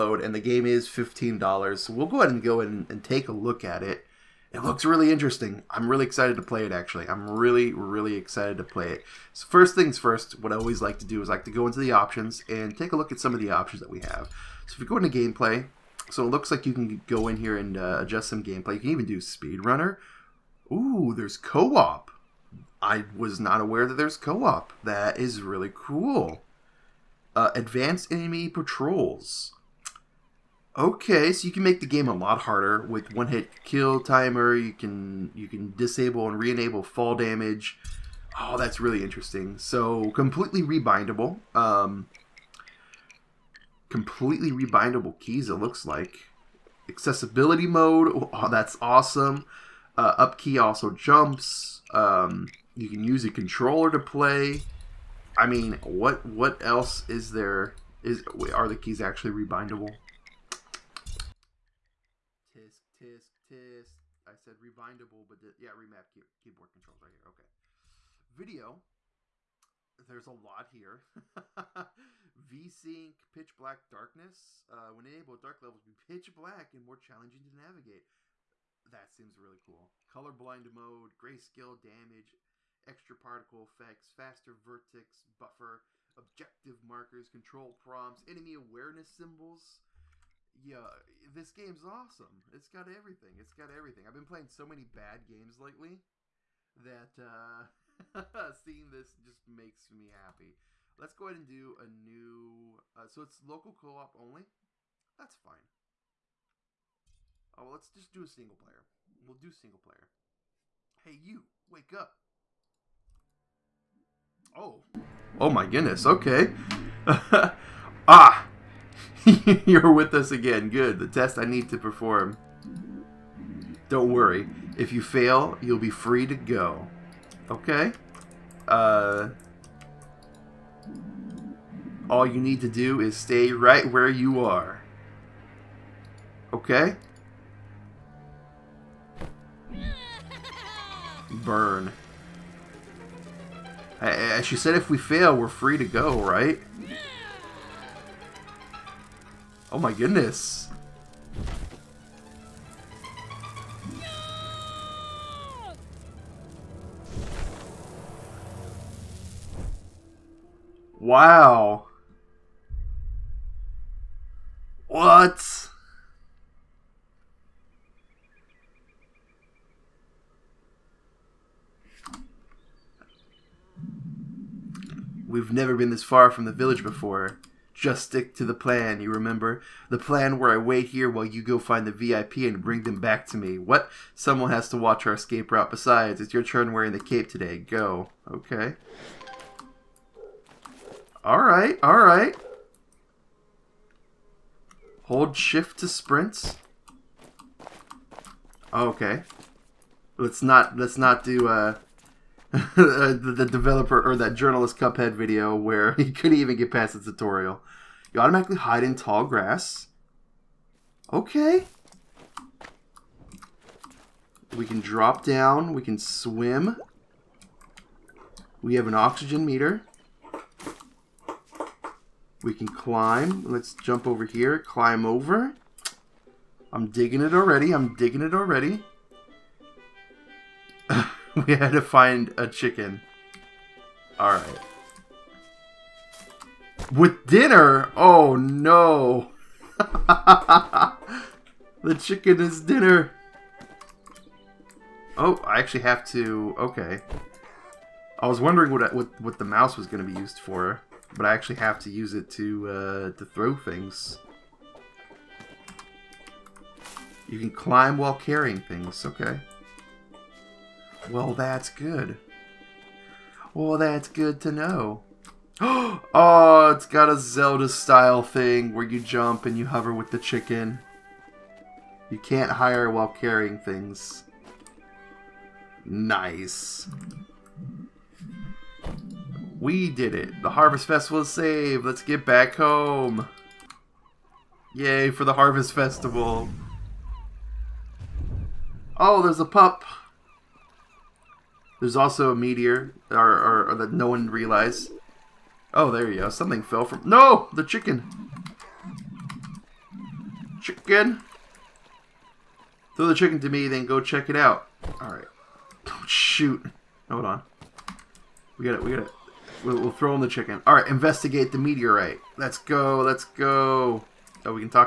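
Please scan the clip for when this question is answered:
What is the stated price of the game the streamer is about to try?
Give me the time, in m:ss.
0:00.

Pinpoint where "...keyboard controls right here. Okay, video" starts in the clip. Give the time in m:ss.
1:06.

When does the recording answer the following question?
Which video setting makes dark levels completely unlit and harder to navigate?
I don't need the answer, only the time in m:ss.
1:13.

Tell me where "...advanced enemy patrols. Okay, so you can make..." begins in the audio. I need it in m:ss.
0:27.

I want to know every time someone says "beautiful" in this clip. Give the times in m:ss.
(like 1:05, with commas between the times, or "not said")
not said.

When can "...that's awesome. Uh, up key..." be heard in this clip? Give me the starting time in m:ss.
0:48.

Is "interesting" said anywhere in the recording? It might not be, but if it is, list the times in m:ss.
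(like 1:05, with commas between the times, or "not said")
0:05, 0:39.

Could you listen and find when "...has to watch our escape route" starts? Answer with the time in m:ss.
3:04.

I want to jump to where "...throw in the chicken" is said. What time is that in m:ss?
5:09.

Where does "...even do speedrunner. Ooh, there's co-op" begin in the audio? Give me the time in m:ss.
0:18.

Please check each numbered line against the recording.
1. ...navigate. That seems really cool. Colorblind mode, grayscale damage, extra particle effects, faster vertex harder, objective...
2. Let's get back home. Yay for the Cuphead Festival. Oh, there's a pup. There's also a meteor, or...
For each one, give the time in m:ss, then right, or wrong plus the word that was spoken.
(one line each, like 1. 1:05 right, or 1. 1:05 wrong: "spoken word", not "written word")
1. 1:17 wrong: "buffer", not "harder"
2. 4:41 wrong: "Harvest", not "Cuphead".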